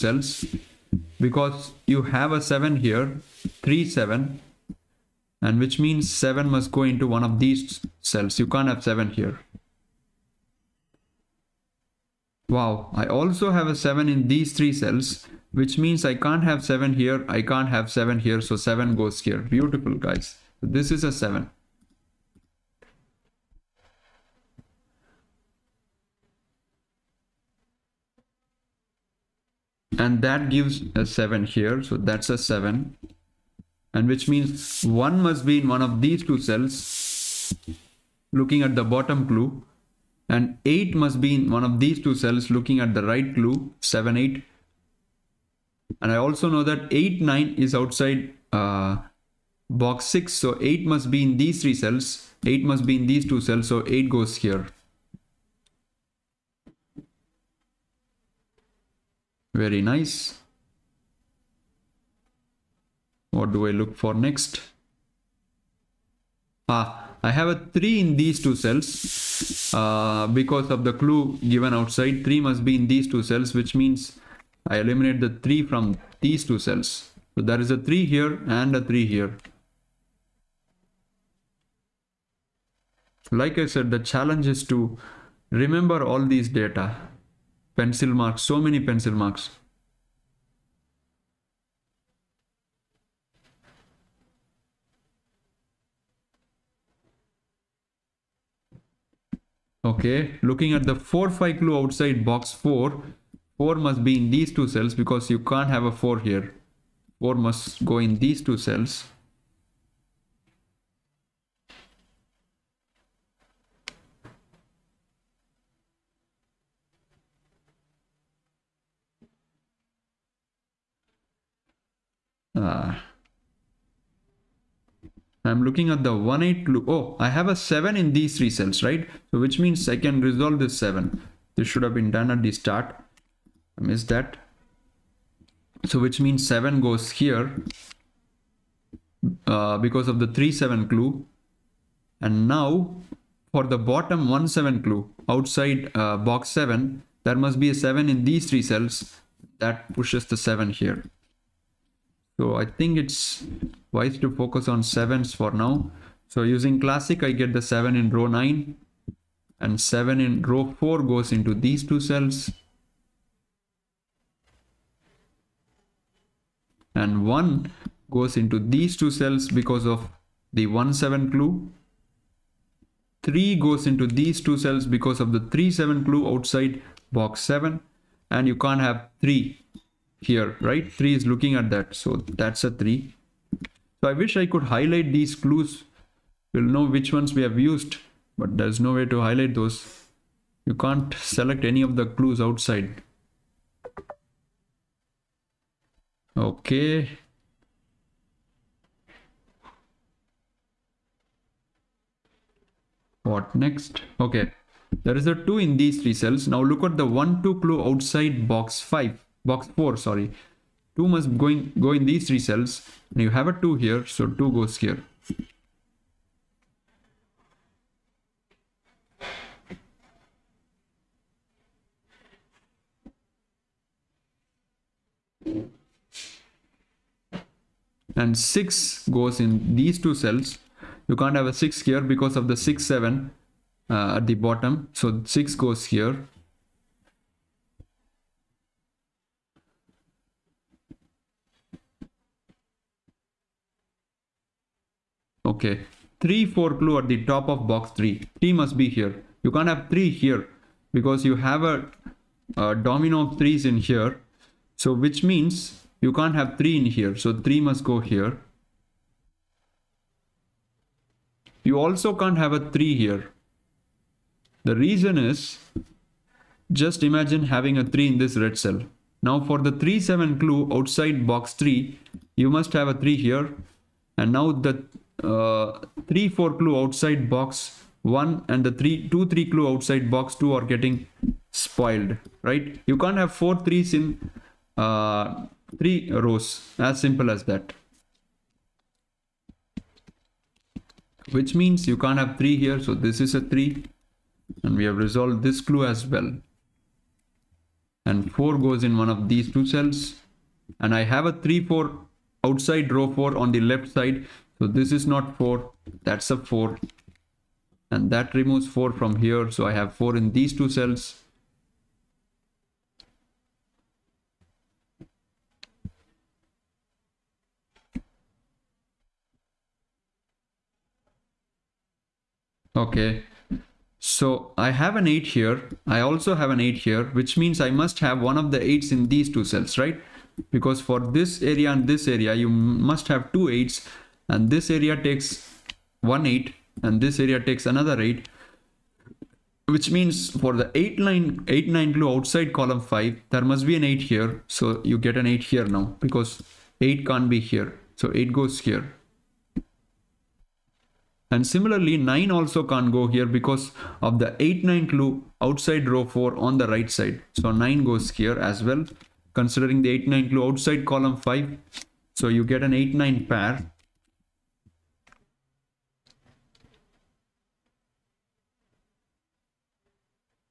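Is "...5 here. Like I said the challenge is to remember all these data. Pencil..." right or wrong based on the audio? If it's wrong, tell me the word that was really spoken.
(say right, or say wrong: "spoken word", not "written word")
wrong: "3", not "5".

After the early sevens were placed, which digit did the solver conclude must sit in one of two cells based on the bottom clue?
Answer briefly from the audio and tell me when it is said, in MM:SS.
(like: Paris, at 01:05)
1, at 00:34.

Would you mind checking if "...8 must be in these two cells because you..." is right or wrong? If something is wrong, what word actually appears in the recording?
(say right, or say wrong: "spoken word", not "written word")
wrong: "4", not "8".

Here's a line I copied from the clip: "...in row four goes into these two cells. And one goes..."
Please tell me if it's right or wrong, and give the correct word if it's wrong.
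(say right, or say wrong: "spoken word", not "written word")
right.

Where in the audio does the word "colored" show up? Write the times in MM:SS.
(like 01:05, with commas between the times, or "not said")
not said.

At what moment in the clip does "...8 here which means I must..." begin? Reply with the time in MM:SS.
05:26.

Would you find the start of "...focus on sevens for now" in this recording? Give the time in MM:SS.
02:34.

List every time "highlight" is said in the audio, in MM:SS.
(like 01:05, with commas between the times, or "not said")
03:04, 03:09.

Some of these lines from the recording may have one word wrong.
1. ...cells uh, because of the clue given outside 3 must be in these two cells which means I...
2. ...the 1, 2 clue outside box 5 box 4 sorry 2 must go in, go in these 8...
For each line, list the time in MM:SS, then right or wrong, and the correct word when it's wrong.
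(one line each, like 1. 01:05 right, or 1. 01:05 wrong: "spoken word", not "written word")
1. 01:08 right
2. 03:26 wrong: "3", not "8".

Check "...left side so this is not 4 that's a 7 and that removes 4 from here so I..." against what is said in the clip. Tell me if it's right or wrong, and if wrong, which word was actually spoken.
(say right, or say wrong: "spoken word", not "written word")
wrong: "4", not "7".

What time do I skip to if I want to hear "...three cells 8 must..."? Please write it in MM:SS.
00:51.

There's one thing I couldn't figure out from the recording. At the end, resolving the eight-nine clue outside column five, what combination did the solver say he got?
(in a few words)
An 8 9 pair.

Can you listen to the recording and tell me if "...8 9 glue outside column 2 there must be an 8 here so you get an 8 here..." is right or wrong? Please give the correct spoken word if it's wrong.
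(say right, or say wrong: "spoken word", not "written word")
wrong: "5", not "2".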